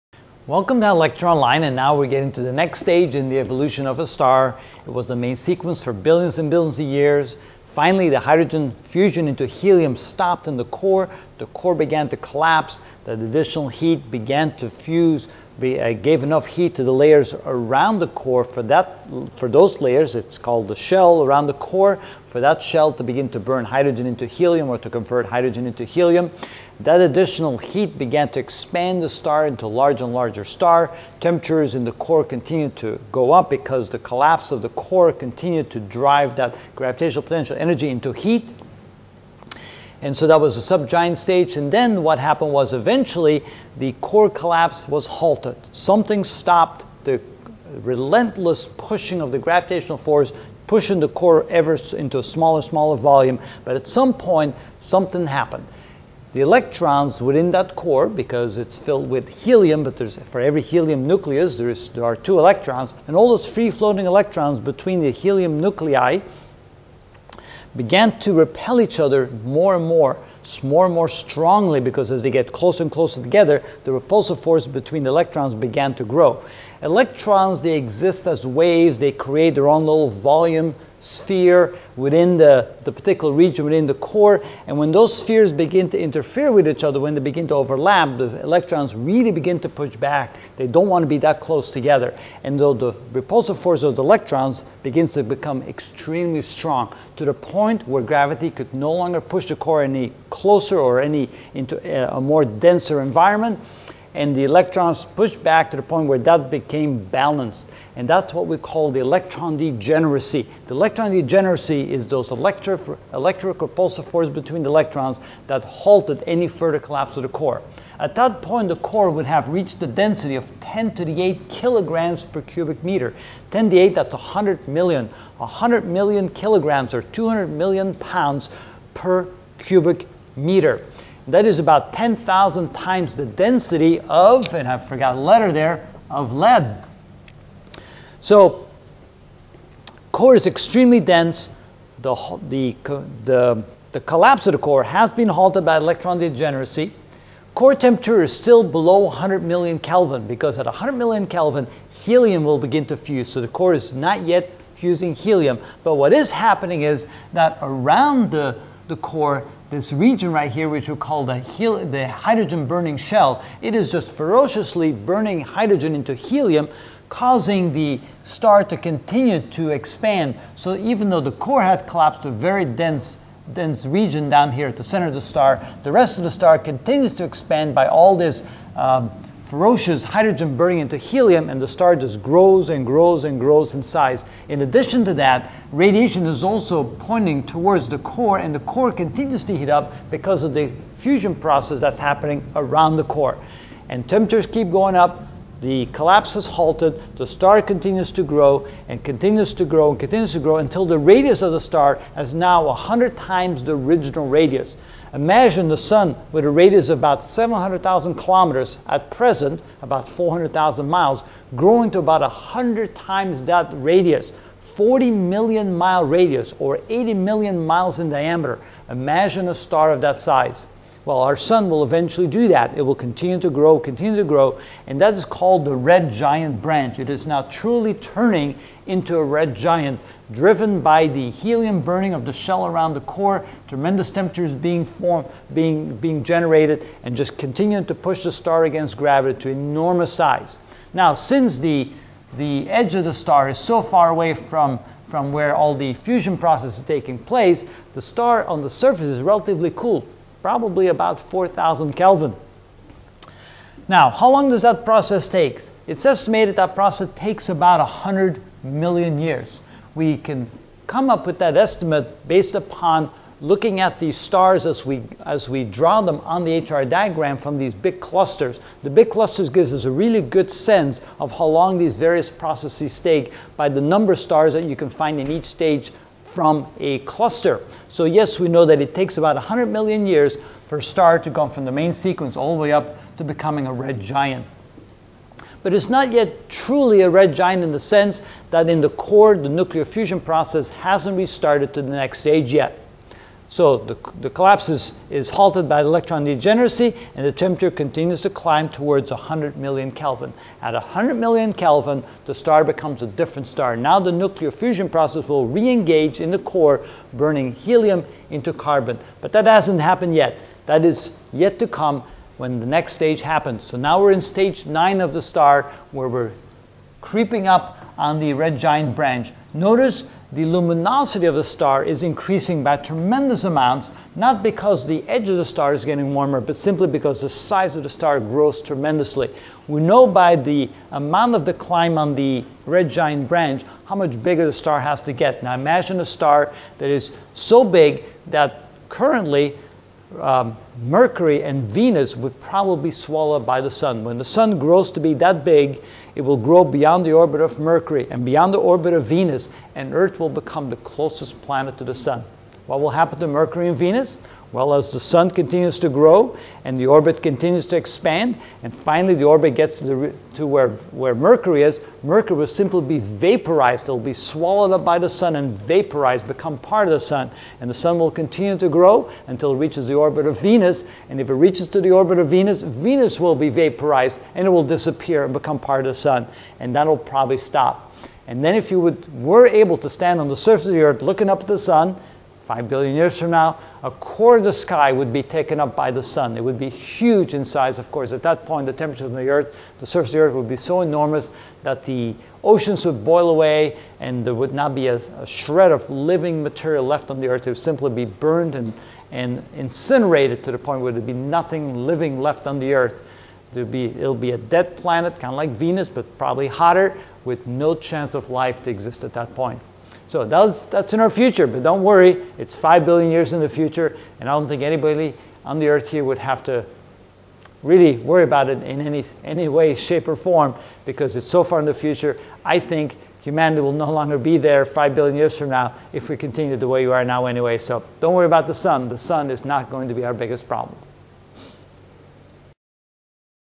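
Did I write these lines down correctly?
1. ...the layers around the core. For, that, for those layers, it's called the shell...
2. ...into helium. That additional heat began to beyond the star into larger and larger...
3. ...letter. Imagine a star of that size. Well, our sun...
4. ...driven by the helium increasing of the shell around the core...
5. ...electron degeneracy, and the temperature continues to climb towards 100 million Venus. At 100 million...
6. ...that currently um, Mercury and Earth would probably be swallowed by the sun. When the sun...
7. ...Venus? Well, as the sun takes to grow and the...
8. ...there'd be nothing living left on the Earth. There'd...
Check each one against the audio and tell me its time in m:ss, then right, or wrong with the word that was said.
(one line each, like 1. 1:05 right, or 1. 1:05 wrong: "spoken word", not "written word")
1. 0:16 right
2. 0:25 wrong: "expand", not "beyond"
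3. 3:38 wrong: "diameter", not "letter"
4. 3:50 wrong: "burning", not "increasing"
5. 4:55 wrong: "Kelvin", not "Venus"
6. 5:38 wrong: "Venus", not "Earth"
7. 5:53 wrong: "continues", not "takes"
8. 6:40 right.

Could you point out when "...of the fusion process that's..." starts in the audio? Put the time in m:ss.
3:10.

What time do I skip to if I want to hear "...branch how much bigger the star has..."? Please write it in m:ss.
5:33.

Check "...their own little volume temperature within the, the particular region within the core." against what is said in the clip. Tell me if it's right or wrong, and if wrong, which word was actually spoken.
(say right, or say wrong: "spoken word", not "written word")
wrong: "sphere", not "temperature".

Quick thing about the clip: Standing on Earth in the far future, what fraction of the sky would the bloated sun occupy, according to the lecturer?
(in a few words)
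A quarter.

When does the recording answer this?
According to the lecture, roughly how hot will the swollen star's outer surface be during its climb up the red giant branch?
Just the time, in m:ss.
4:11.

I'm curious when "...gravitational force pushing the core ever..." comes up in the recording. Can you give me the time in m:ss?
0:49.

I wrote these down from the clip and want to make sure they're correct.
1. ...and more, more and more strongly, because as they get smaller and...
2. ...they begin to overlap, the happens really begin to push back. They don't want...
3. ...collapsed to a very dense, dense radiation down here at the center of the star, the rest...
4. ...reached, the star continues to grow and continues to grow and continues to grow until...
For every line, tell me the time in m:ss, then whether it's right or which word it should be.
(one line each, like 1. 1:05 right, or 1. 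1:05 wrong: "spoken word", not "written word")
1. 1:09 wrong: "closer", not "smaller"
2. 1:27 wrong: "electrons", not "happens"
3. 2:51 wrong: "region", not "radiation"
4. 3:16 wrong: "halted", not "reached".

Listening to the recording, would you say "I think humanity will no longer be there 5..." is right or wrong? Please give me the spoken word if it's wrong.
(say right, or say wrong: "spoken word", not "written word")
right.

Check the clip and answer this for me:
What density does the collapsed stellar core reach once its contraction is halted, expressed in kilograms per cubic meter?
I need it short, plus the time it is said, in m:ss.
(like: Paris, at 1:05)
10^8 kg per cubic meter, at 2:00.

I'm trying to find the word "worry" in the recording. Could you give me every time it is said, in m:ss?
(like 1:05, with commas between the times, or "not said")
6:51, 6:57, 7:08.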